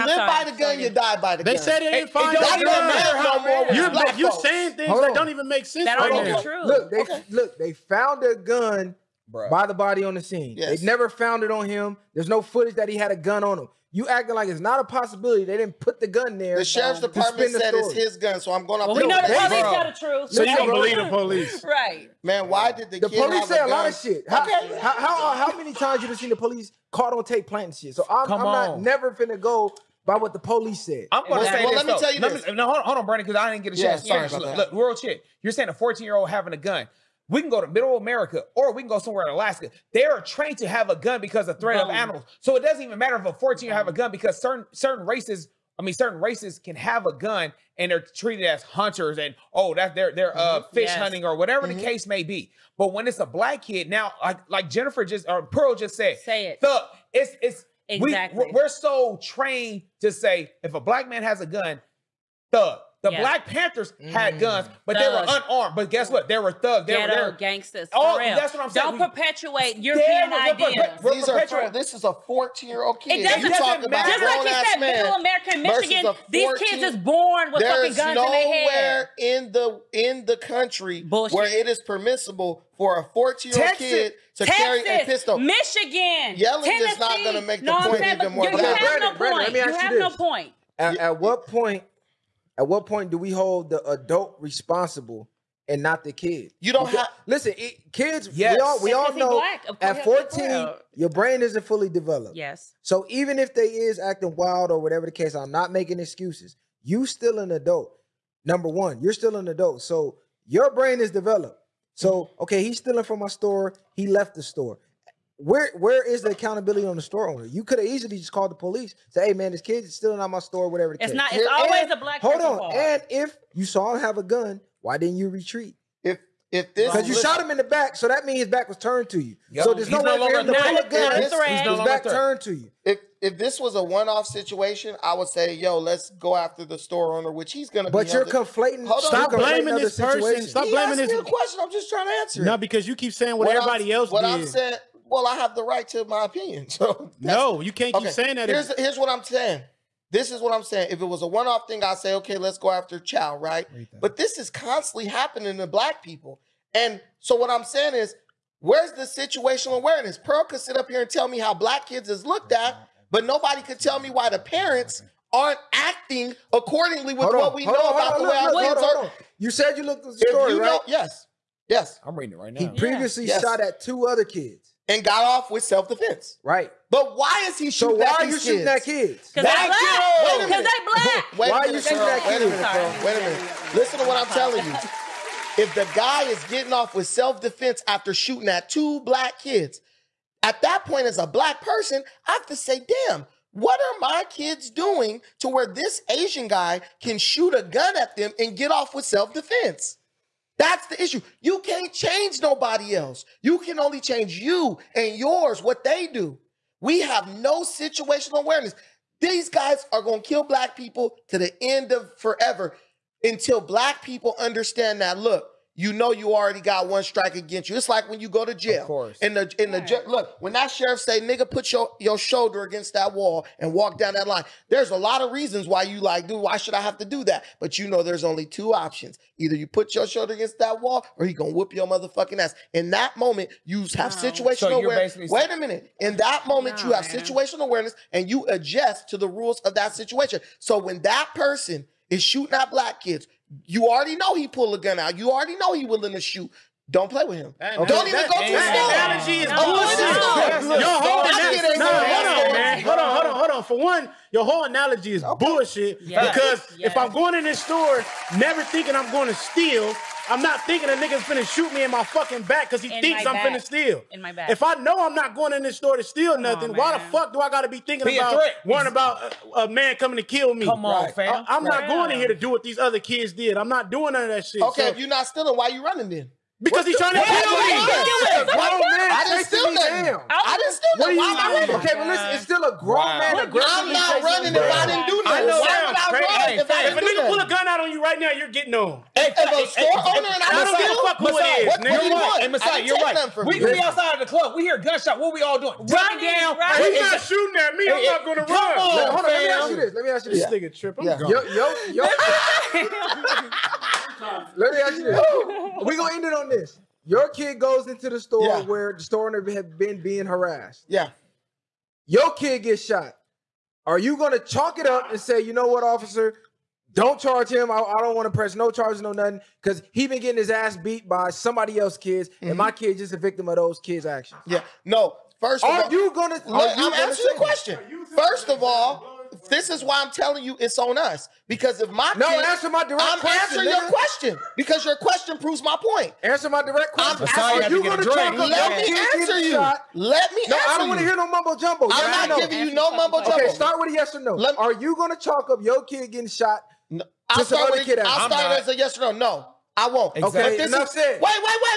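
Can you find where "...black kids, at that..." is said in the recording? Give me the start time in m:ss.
3:09.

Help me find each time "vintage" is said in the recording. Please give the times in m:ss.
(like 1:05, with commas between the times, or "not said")
not said.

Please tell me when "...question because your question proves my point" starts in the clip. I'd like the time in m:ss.
5:33.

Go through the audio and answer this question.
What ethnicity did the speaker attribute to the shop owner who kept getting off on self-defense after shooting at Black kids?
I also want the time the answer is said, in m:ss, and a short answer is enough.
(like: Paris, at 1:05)
Asian, at 3:16.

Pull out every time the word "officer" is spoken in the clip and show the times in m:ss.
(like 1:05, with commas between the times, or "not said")
5:15.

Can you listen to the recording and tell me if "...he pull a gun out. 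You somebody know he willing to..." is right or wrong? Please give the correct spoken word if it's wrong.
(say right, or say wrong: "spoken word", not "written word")
wrong: "already", not "somebody".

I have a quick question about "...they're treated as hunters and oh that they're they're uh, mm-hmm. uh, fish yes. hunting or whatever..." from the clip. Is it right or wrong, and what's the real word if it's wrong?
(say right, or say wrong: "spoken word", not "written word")
right.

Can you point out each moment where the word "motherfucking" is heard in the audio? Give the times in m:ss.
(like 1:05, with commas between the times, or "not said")
3:51.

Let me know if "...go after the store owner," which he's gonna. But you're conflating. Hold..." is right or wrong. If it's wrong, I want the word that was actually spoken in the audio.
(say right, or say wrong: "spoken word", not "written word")
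right.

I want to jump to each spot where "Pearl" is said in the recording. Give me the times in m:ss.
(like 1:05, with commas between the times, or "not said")
0:55, 2:40.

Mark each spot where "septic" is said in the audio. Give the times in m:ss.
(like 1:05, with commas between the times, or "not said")
not said.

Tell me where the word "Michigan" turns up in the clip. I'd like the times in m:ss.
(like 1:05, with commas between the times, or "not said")
1:15, 1:25.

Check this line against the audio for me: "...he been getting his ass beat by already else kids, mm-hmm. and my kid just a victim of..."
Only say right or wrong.
wrong.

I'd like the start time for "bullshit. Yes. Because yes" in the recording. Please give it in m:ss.
4:15.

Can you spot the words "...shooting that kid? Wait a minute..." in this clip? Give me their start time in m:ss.
3:01.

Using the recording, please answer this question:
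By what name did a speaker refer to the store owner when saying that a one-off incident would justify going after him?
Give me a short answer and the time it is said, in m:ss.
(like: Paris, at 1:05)
Chow, at 2:32.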